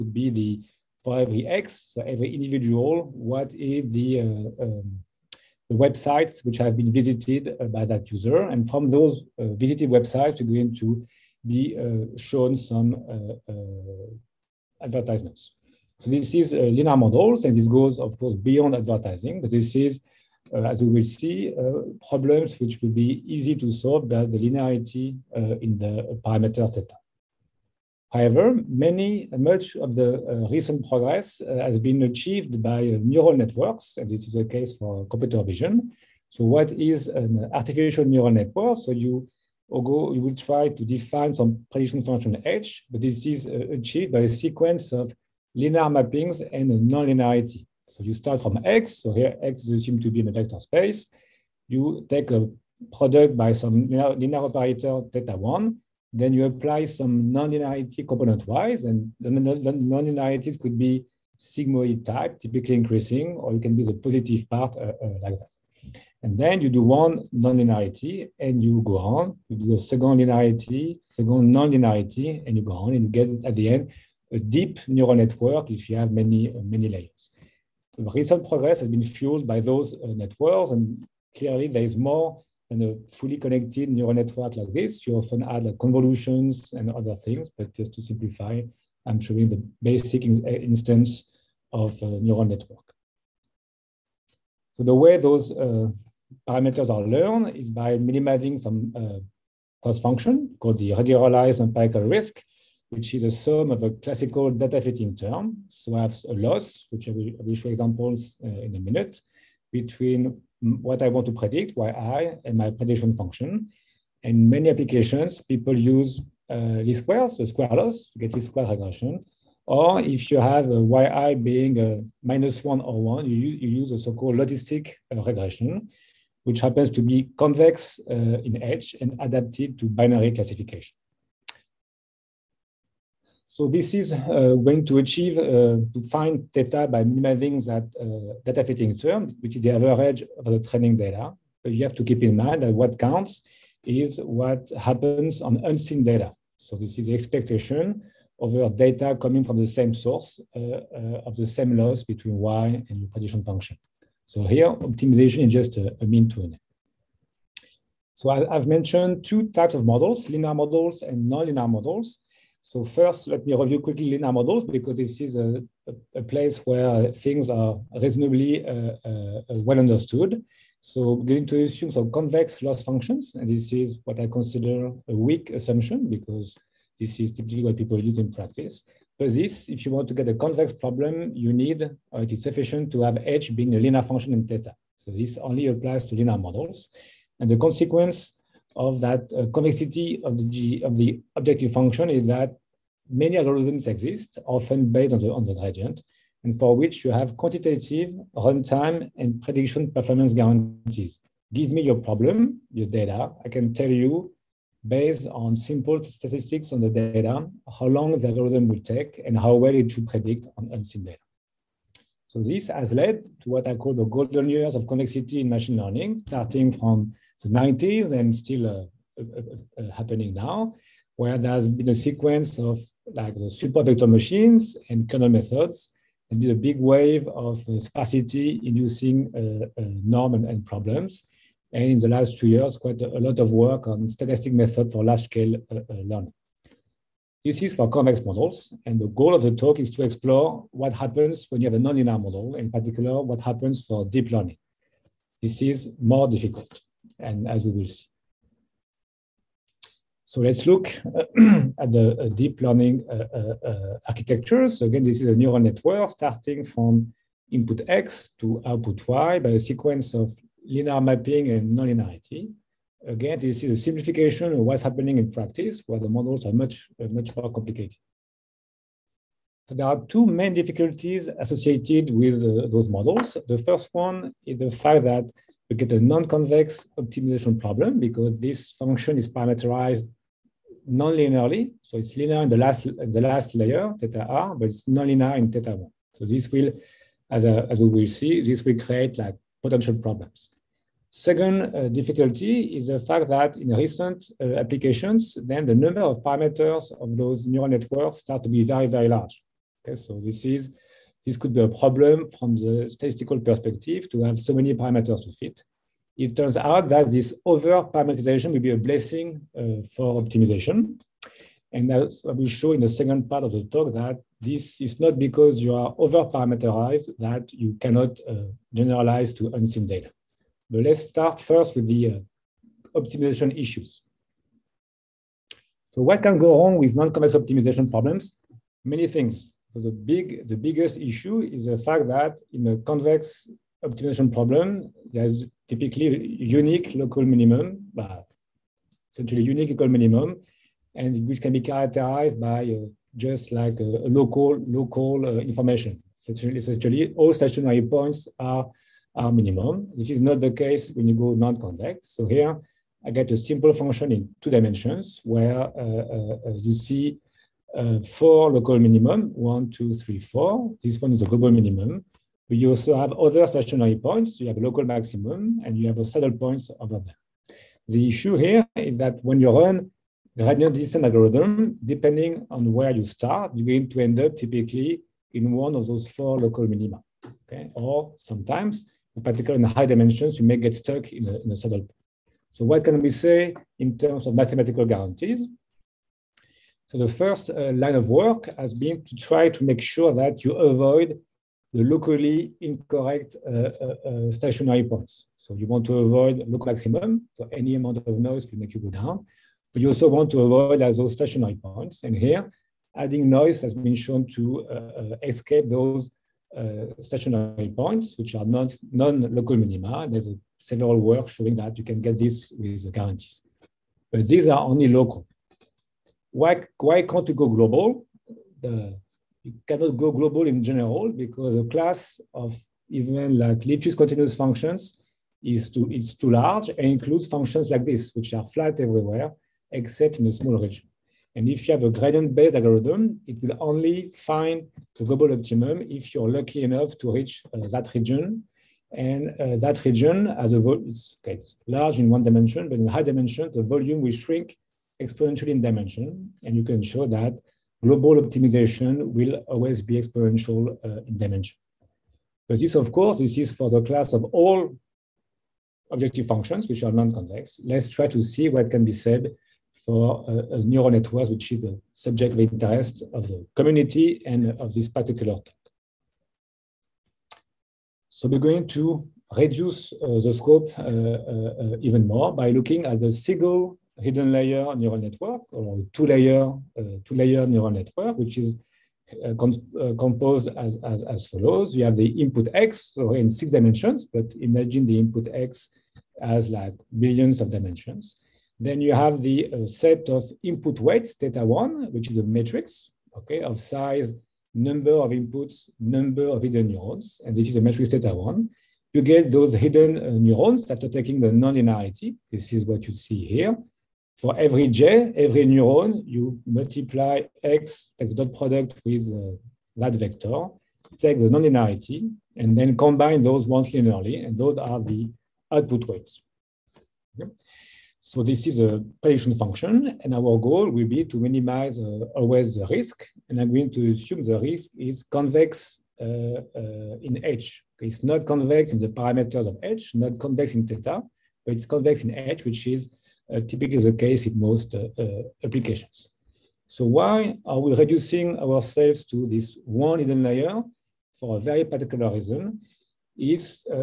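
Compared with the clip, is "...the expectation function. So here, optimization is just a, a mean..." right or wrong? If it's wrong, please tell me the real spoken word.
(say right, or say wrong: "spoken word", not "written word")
wrong: "prediction", not "expectation".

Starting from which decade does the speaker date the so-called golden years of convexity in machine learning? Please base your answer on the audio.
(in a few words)
the 90s.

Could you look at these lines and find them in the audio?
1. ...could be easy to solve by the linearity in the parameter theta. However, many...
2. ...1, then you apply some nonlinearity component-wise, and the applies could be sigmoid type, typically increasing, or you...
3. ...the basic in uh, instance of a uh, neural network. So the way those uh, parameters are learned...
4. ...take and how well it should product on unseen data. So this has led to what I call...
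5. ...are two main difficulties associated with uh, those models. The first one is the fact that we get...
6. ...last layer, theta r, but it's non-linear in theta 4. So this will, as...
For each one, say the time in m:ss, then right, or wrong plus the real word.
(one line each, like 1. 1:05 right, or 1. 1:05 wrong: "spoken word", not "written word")
1. 0:22 right
2. 0:55 wrong: "nonlinearities", not "applies"
3. 1:29 right
4. 3:28 wrong: "predict", not "product"
5. 4:29 right
6. 4:43 wrong: "1", not "4".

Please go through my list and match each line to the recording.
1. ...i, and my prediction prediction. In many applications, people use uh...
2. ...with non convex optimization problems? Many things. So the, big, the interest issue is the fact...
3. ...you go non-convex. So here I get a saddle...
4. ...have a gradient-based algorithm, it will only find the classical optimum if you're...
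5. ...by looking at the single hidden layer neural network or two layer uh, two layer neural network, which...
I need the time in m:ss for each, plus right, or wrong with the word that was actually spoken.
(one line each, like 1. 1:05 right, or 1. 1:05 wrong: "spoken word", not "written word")
1. 1:51 wrong: "function", not "prediction"
2. 5:26 wrong: "biggest", not "interest"
3. 5:51 wrong: "simple", not "saddle"
4. 7:11 wrong: "global", not "classical"
5. 7:52 right.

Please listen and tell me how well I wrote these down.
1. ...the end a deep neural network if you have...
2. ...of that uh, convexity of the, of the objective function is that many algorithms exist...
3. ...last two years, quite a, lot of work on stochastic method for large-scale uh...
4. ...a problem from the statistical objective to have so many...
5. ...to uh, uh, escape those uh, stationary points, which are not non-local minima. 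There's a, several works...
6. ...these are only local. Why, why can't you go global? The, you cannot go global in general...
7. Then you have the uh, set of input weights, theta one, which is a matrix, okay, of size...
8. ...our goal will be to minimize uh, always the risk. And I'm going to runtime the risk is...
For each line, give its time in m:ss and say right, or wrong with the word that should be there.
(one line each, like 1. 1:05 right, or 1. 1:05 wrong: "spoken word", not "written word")
1. 1:13 right
2. 3:08 right
3. 3:52 right
4. 5:01 wrong: "perspective", not "objective"
5. 6:44 right
6. 6:54 right
7. 8:08 right
8. 8:40 wrong: "assume", not "runtime".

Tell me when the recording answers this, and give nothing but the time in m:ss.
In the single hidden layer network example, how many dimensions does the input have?
8:03.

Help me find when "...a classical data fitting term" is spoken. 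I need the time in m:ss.
1:43.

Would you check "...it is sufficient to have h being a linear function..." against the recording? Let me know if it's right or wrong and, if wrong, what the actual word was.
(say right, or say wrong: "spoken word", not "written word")
right.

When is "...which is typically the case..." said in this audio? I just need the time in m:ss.
8:52.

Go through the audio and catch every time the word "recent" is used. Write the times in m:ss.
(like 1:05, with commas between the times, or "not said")
0:30, 1:18, 4:53.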